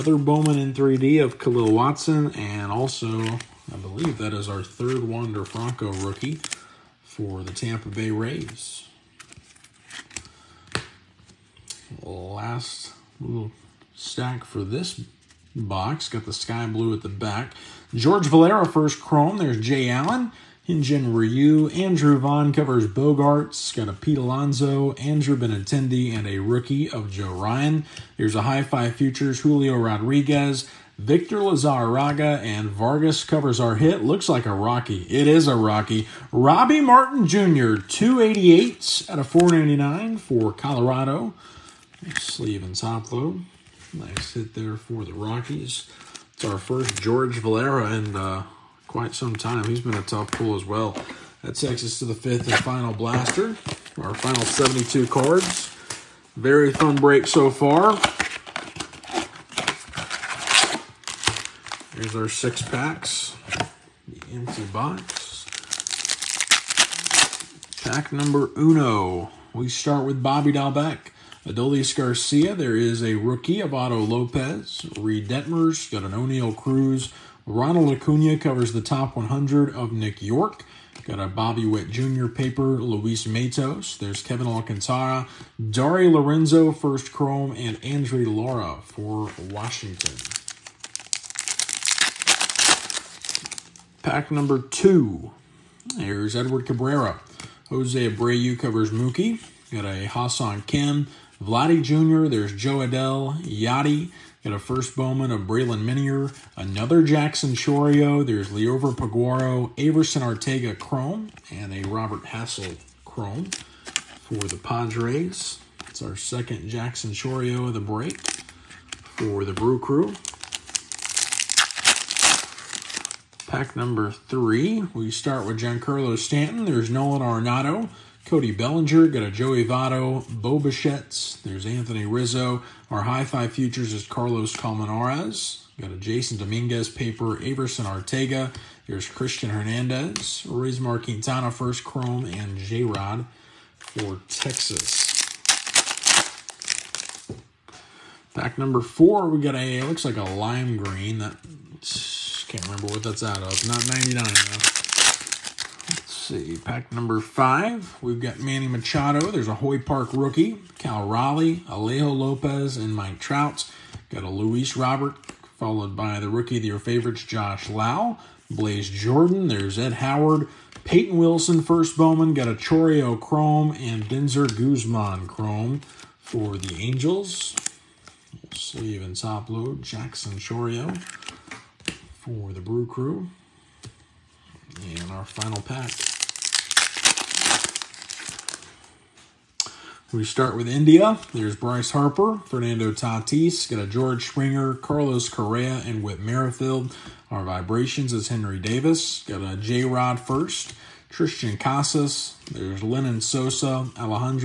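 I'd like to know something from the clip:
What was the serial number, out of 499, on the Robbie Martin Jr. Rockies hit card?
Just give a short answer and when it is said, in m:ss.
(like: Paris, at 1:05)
288, at 0:37.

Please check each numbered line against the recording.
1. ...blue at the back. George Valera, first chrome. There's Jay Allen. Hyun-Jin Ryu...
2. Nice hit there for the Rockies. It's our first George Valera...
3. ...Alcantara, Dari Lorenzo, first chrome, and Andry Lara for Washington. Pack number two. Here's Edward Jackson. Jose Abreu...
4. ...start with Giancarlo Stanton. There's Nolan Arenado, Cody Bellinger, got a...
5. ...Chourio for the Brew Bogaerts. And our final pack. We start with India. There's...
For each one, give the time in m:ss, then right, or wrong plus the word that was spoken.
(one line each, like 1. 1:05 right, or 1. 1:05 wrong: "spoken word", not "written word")
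1. 0:16 right
2. 0:43 right
3. 1:24 wrong: "Cabrera", not "Jackson"
4. 2:05 right
5. 3:00 wrong: "Crew", not "Bogaerts".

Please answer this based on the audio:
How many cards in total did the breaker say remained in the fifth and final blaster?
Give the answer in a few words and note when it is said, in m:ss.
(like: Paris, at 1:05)
72, at 0:54.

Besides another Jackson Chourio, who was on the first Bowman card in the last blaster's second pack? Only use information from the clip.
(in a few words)
Braylon Minier.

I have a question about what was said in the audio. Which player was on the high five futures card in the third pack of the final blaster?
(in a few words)
Carlos Colmenares.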